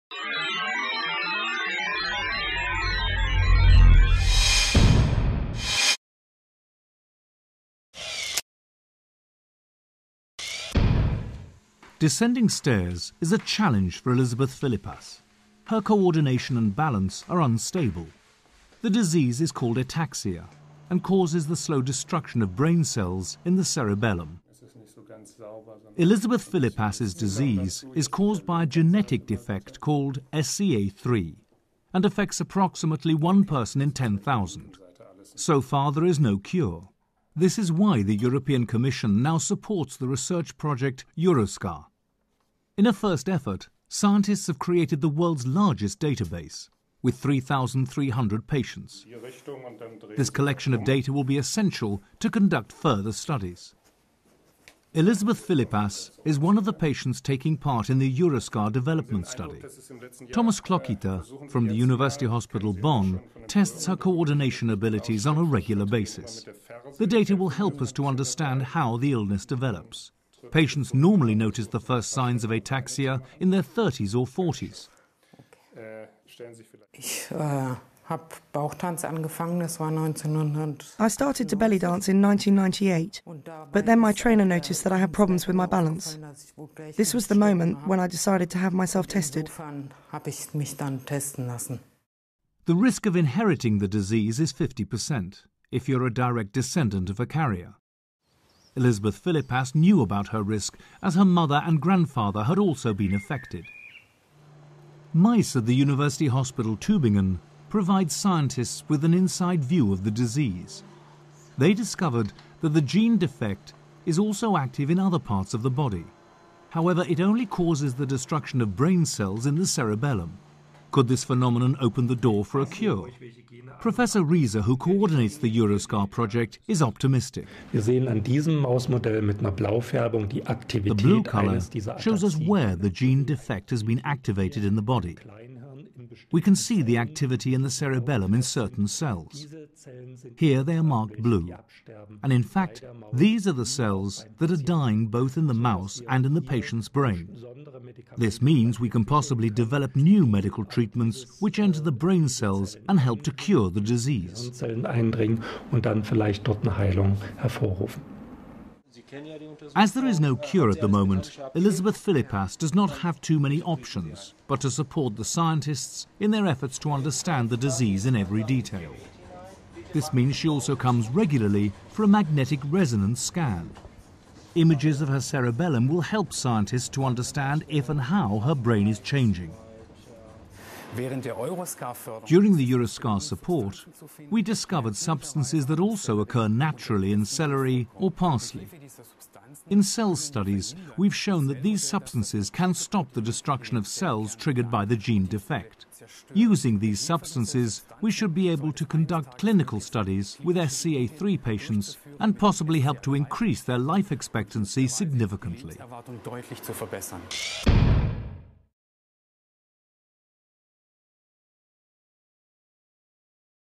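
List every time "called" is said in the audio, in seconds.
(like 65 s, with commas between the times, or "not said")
19 s, 29 s.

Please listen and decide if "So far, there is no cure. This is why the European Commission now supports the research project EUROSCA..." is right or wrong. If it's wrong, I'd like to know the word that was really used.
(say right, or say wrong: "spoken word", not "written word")
right.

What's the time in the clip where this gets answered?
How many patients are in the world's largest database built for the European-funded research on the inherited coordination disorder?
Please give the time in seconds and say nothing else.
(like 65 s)
47 s.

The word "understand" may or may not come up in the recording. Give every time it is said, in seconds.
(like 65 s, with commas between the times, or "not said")
68 s, 166 s, 177 s.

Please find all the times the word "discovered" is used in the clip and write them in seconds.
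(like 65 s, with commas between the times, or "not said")
111 s, 184 s.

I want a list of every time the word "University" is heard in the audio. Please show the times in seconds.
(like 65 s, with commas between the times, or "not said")
61 s, 105 s.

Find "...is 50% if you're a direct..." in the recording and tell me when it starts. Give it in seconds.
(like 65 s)
94 s.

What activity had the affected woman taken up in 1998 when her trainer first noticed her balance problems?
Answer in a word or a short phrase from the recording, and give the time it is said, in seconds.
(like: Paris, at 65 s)
belly dance, at 81 s.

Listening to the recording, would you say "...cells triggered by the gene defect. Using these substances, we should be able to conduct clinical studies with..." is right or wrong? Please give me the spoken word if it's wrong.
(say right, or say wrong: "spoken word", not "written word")
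right.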